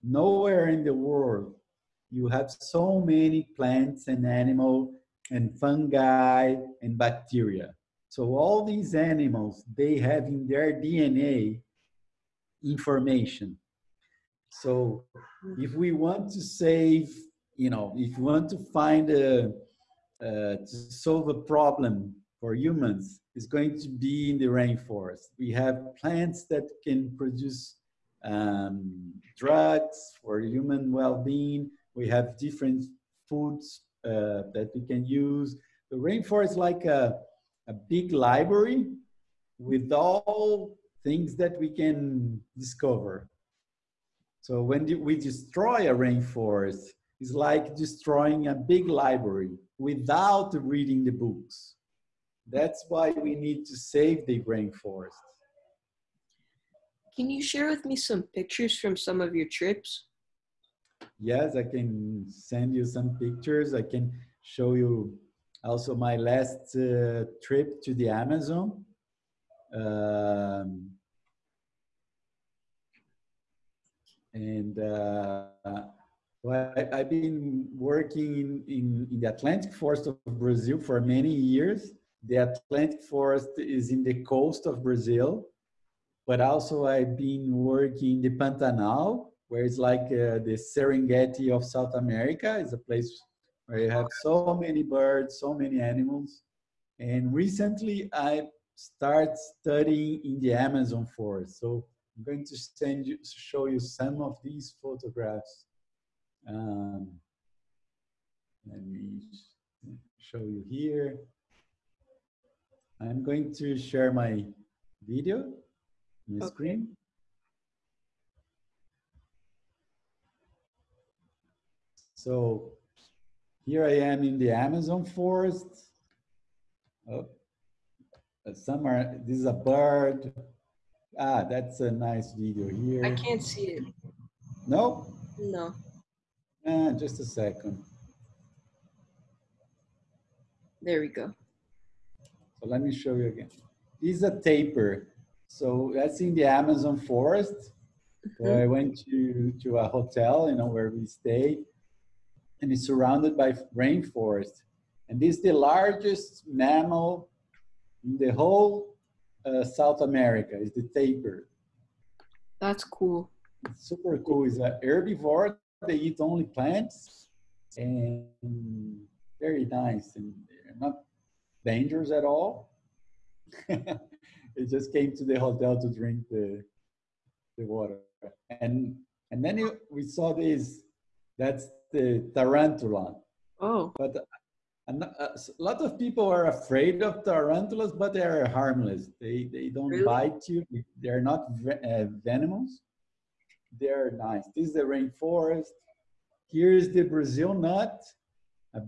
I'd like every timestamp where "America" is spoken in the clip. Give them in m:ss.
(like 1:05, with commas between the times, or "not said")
1:31, 2:40.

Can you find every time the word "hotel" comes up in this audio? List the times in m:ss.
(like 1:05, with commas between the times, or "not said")
2:29, 2:55.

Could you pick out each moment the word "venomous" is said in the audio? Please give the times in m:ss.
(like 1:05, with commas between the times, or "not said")
3:12.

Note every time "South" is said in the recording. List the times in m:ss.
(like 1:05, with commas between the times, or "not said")
1:31, 2:39.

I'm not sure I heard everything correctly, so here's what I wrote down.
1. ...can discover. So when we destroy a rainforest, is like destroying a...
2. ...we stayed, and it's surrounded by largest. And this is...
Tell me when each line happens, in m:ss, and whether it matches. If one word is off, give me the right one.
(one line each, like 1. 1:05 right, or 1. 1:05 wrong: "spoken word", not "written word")
1. 0:41 right
2. 2:30 wrong: "rainforest", not "largest".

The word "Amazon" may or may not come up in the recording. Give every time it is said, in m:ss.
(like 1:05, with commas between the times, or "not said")
1:08, 1:40, 2:04, 2:26.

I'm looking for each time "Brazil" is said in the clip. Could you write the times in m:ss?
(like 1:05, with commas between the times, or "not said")
1:20, 1:24, 3:17.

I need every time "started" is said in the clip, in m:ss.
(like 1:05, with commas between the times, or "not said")
1:38.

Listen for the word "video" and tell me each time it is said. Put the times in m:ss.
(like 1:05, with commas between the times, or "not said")
1:55, 2:12.